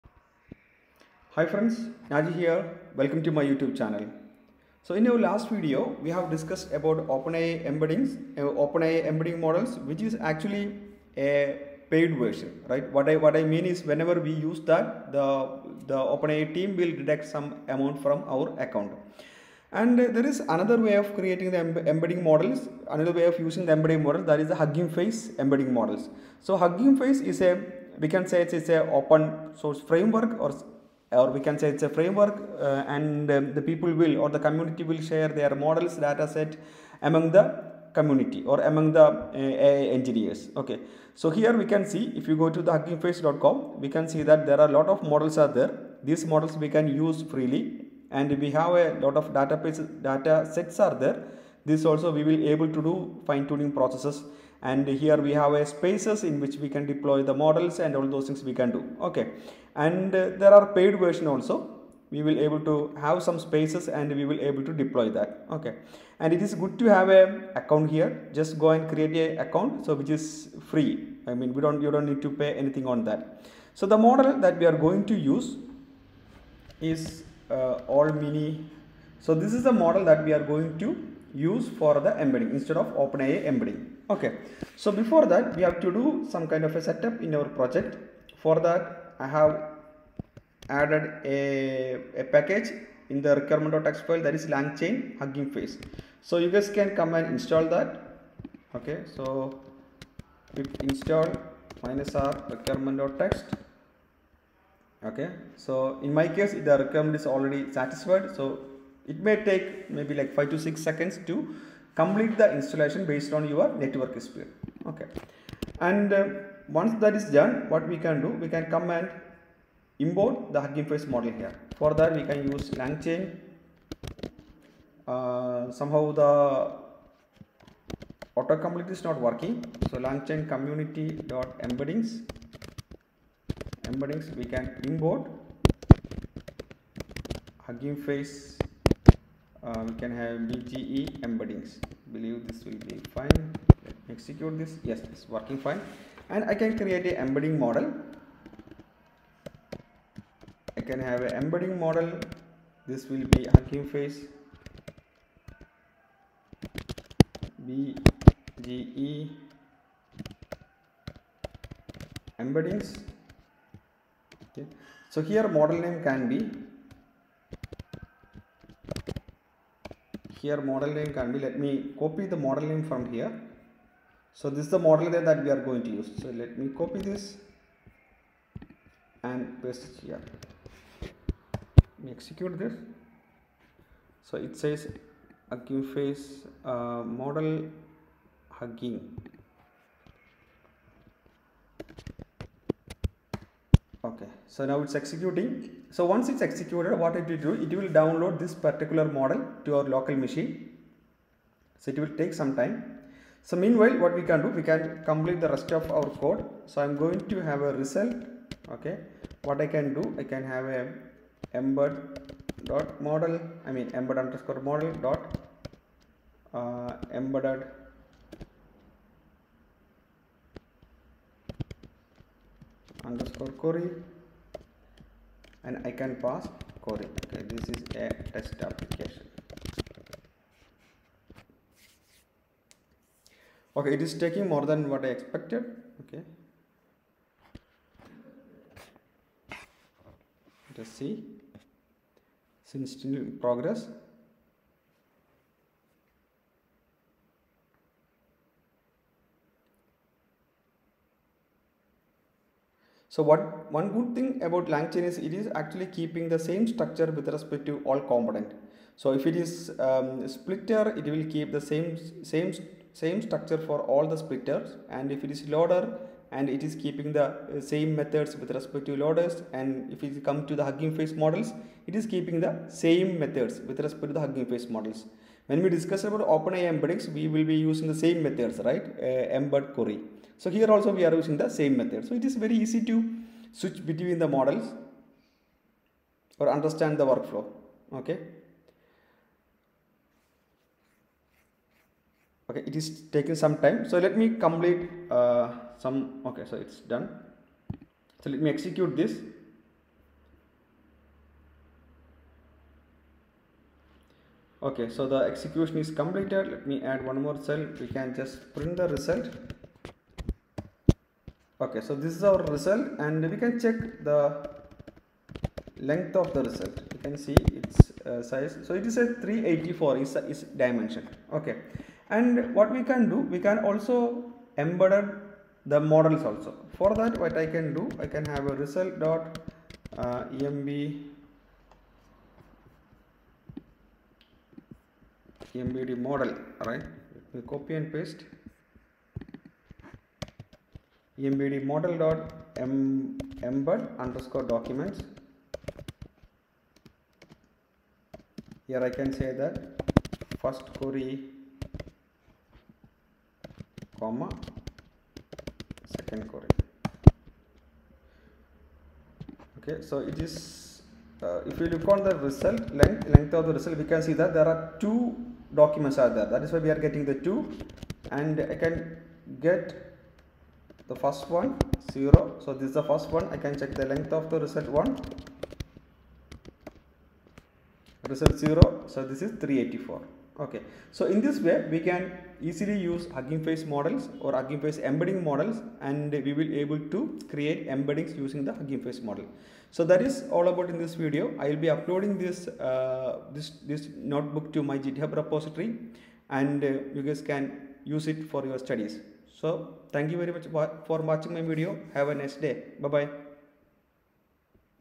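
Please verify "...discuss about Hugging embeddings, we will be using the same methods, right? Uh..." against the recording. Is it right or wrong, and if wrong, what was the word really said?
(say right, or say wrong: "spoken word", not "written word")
wrong: "OpenAI", not "Hugging".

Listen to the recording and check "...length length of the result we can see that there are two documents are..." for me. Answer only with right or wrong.
right.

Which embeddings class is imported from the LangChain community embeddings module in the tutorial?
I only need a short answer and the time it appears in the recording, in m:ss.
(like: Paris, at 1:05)
Hugging Face BGE embeddings, at 2:33.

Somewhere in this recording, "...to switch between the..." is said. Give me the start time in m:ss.
4:42.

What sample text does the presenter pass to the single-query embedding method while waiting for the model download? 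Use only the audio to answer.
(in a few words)
this is a test application.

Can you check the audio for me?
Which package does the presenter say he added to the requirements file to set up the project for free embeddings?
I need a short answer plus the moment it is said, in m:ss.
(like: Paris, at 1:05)
langchain hugging face, at 1:34.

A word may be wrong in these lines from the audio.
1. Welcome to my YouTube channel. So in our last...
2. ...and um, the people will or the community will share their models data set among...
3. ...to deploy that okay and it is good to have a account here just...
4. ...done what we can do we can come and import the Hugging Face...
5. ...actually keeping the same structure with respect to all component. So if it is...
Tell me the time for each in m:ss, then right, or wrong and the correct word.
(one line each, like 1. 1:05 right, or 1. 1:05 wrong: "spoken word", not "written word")
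1. 0:02 right
2. 0:32 right
3. 1:04 right
4. 1:57 right
5. 4:15 right.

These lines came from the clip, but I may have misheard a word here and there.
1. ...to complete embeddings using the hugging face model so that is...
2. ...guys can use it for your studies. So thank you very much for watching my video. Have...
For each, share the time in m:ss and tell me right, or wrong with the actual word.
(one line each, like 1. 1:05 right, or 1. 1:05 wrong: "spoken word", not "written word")
1. 6:26 wrong: "create", not "complete"
2. 6:37 right.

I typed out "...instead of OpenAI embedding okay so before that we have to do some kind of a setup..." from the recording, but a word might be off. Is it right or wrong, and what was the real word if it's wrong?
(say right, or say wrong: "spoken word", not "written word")
right.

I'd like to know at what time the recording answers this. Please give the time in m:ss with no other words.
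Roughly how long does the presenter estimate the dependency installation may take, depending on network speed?
1:50.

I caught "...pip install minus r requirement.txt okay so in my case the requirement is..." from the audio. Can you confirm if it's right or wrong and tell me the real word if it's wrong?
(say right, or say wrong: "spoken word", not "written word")
right.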